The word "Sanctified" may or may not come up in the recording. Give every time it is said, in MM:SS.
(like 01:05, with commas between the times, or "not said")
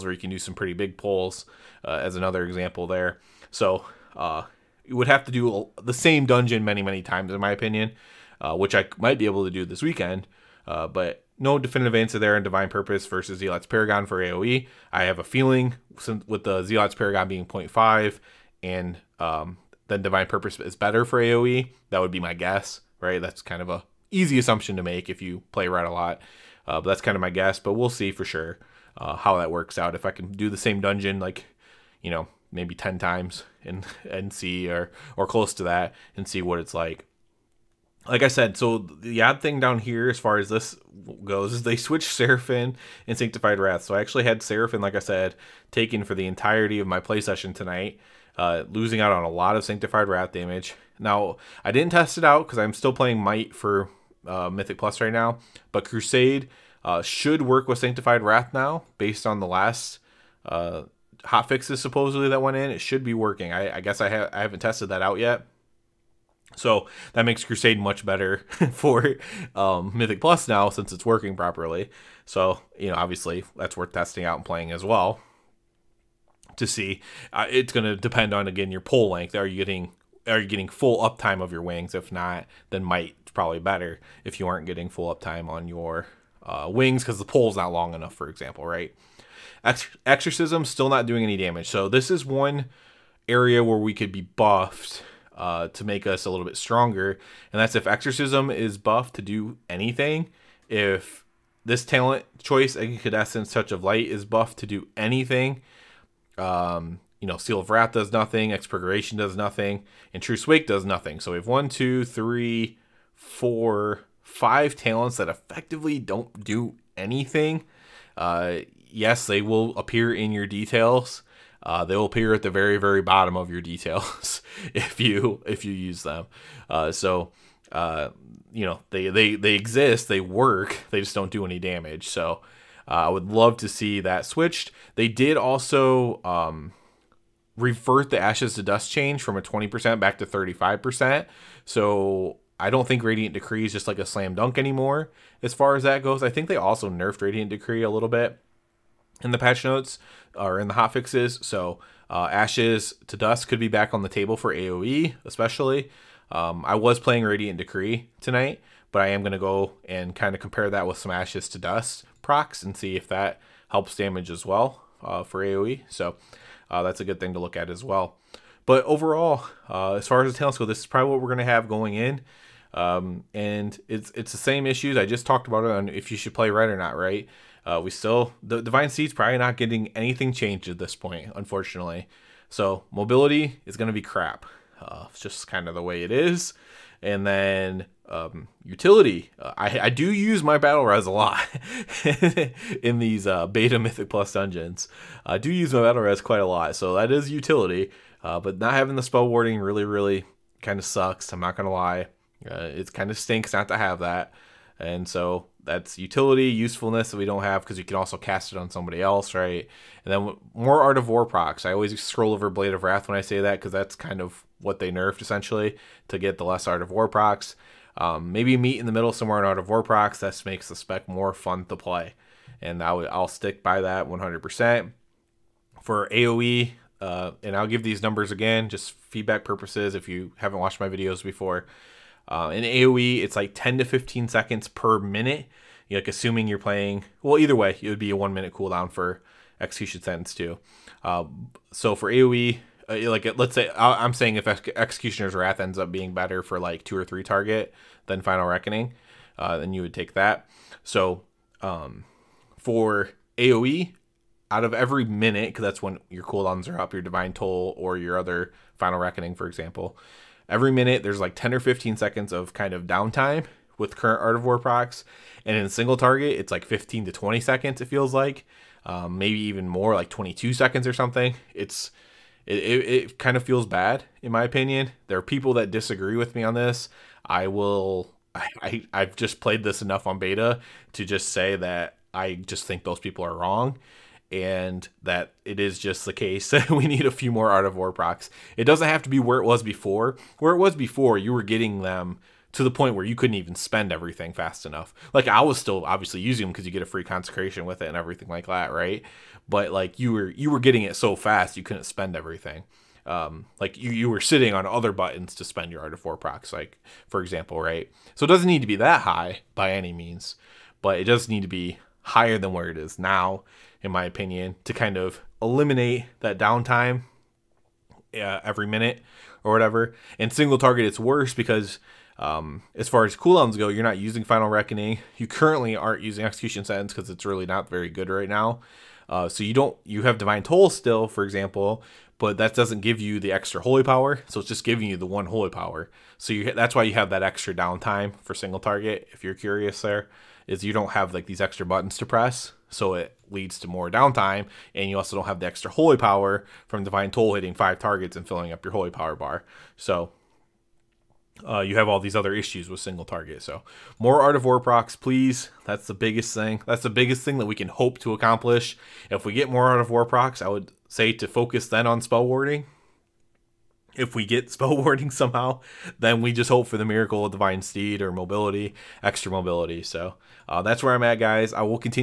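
00:43, 00:49, 00:57.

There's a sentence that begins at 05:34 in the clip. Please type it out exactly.
So it's just giving you the one holy power.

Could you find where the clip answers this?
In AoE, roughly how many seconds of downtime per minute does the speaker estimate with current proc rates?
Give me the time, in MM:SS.
03:53.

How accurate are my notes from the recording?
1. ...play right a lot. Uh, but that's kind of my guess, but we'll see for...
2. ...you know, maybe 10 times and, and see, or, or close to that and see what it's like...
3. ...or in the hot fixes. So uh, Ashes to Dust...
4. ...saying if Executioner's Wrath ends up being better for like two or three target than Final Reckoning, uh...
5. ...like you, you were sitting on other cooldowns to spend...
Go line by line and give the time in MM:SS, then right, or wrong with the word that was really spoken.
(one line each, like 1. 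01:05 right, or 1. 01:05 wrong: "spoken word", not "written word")
1. 00:25 right
2. 00:32 right
3. 02:30 right
4. 04:04 right
5. 05:03 wrong: "buttons", not "cooldowns".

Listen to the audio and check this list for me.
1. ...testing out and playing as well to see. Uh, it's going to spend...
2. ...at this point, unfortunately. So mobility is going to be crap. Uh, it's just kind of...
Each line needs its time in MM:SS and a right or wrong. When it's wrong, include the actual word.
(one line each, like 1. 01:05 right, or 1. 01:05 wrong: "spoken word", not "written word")
1. 01:13 wrong: "depend", not "spend"
2. 03:00 right.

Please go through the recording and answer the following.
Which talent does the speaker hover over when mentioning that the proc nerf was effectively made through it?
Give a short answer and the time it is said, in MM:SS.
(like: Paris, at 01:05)
Blade of Wrath, at 03:32.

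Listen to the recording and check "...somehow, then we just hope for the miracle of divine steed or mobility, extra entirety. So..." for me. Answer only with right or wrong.
wrong.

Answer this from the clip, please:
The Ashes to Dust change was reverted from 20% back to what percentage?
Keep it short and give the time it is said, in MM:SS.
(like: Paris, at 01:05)
35%, at 02:20.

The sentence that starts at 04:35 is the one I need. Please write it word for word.
There are people that disagree with me on this.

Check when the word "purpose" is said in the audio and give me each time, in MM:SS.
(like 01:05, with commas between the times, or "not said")
00:12, 00:20, 03:49.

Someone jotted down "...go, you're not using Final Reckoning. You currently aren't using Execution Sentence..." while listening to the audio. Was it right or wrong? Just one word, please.
right.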